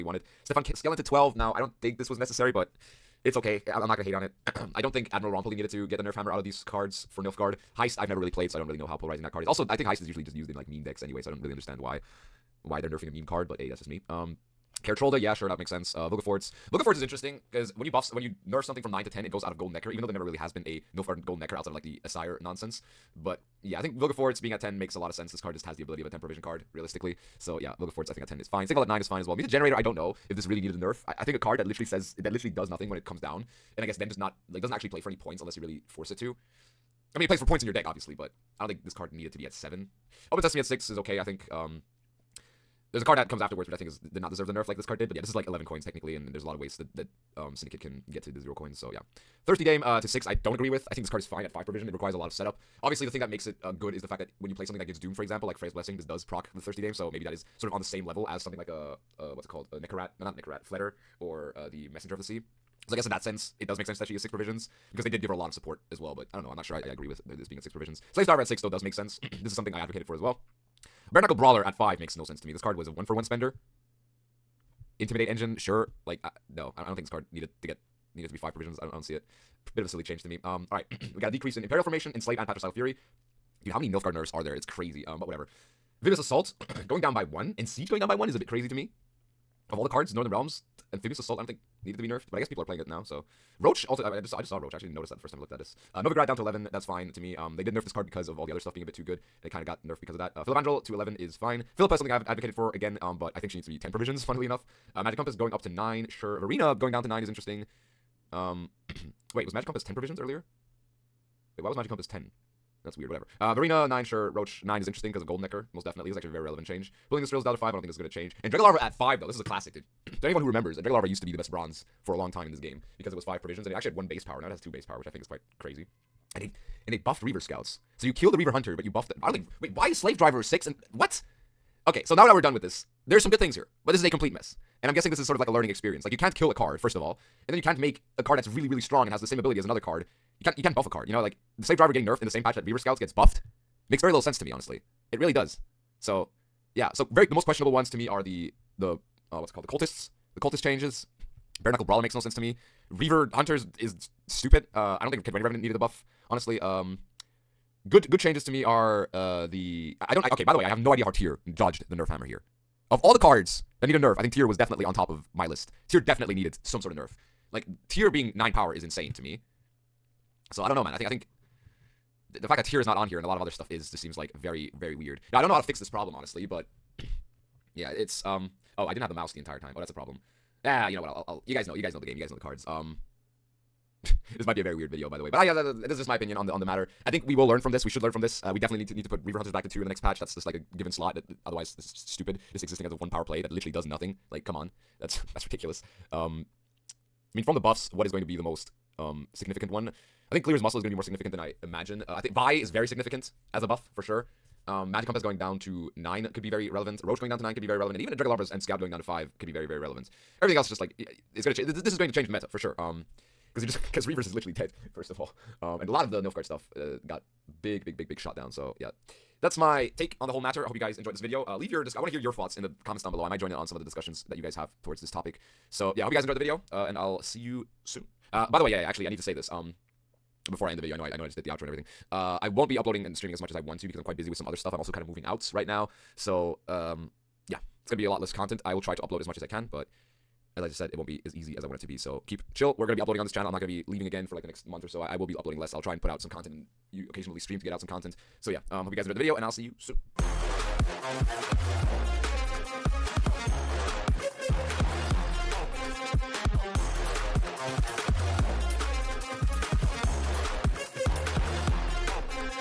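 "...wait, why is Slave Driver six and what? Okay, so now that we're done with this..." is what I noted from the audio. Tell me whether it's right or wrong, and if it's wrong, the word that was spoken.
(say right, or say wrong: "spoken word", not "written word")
right.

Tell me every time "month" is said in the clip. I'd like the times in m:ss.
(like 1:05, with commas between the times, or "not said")
4:04.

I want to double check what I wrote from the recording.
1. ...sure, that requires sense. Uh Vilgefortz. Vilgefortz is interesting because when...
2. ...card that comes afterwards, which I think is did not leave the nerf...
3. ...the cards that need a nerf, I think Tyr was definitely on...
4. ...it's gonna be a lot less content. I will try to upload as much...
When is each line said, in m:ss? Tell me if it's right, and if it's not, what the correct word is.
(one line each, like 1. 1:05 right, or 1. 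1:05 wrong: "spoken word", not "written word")
1. 0:15 wrong: "makes", not "requires"
2. 0:43 wrong: "deserve", not "leave"
3. 2:43 right
4. 3:57 right.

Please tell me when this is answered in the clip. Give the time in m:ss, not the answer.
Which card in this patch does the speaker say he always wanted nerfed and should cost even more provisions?
1:41.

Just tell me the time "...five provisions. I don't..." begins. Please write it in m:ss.
1:18.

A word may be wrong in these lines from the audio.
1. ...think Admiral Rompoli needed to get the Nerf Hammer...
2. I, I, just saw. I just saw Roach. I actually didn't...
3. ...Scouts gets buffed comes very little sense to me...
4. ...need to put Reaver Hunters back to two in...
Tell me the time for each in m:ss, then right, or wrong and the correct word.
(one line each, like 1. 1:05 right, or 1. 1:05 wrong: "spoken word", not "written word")
1. 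0:04 right
2. 1:34 right
3. 2:22 wrong: "makes", not "comes"
4. 3:08 right.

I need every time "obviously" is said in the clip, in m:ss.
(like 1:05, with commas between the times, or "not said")
0:37, 0:52.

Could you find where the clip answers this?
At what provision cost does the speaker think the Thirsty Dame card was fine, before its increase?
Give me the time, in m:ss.
0:51.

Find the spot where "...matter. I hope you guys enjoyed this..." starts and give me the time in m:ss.
3:40.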